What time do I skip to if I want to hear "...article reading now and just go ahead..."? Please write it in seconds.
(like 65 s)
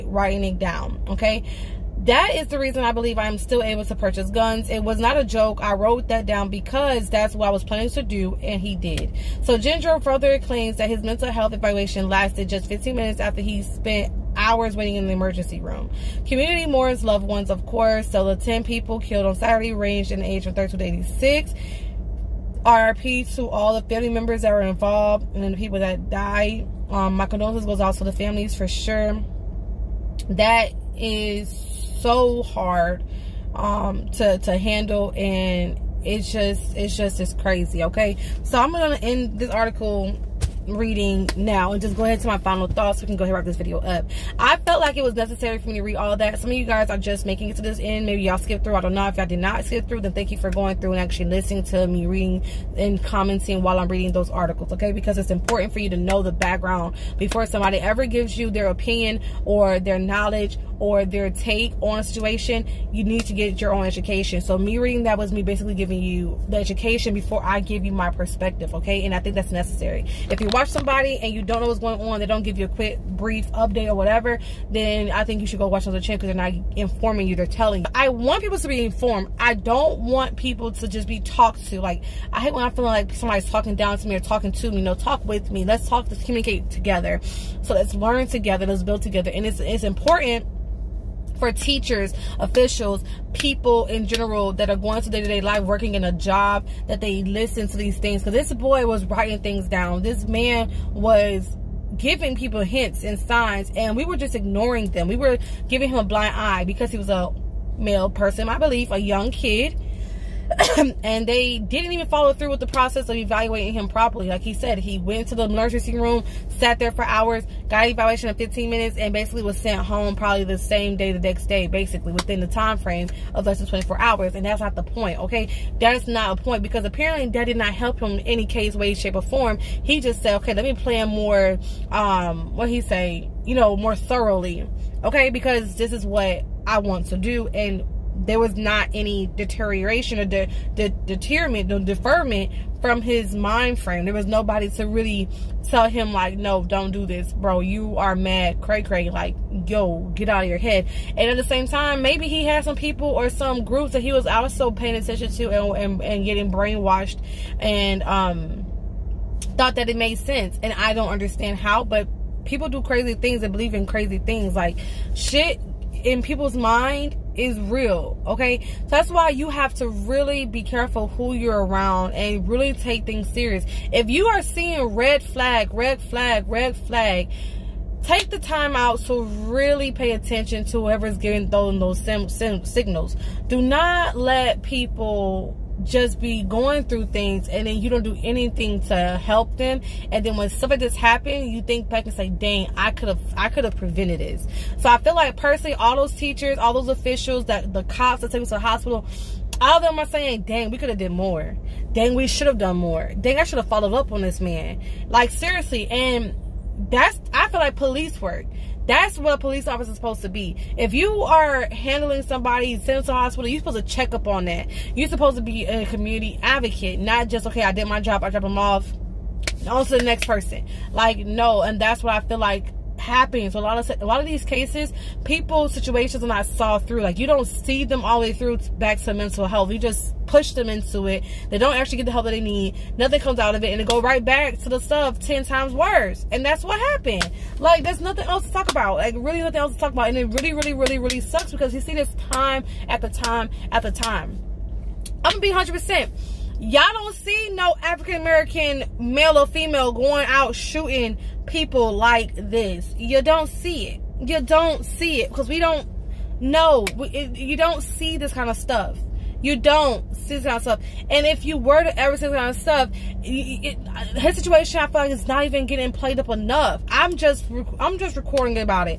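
39 s.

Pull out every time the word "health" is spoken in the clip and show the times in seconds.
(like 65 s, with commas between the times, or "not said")
11 s, 229 s.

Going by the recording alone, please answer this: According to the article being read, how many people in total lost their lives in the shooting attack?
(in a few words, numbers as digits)
10.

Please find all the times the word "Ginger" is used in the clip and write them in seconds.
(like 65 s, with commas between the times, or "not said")
9 s.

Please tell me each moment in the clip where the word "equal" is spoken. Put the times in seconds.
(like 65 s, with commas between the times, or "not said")
not said.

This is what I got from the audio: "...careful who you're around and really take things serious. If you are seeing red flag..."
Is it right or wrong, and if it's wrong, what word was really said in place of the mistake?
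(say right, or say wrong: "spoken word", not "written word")
right.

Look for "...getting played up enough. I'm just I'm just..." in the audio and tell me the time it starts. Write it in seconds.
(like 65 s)
265 s.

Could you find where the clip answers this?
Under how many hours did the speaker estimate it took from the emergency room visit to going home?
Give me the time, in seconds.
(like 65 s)
123 s.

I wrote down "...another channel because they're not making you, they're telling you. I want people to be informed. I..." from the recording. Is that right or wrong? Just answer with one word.
wrong.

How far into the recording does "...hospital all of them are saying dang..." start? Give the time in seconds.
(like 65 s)
198 s.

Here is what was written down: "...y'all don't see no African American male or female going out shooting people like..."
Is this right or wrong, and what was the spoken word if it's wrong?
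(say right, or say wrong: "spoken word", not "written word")
right.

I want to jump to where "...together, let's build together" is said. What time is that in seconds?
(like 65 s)
88 s.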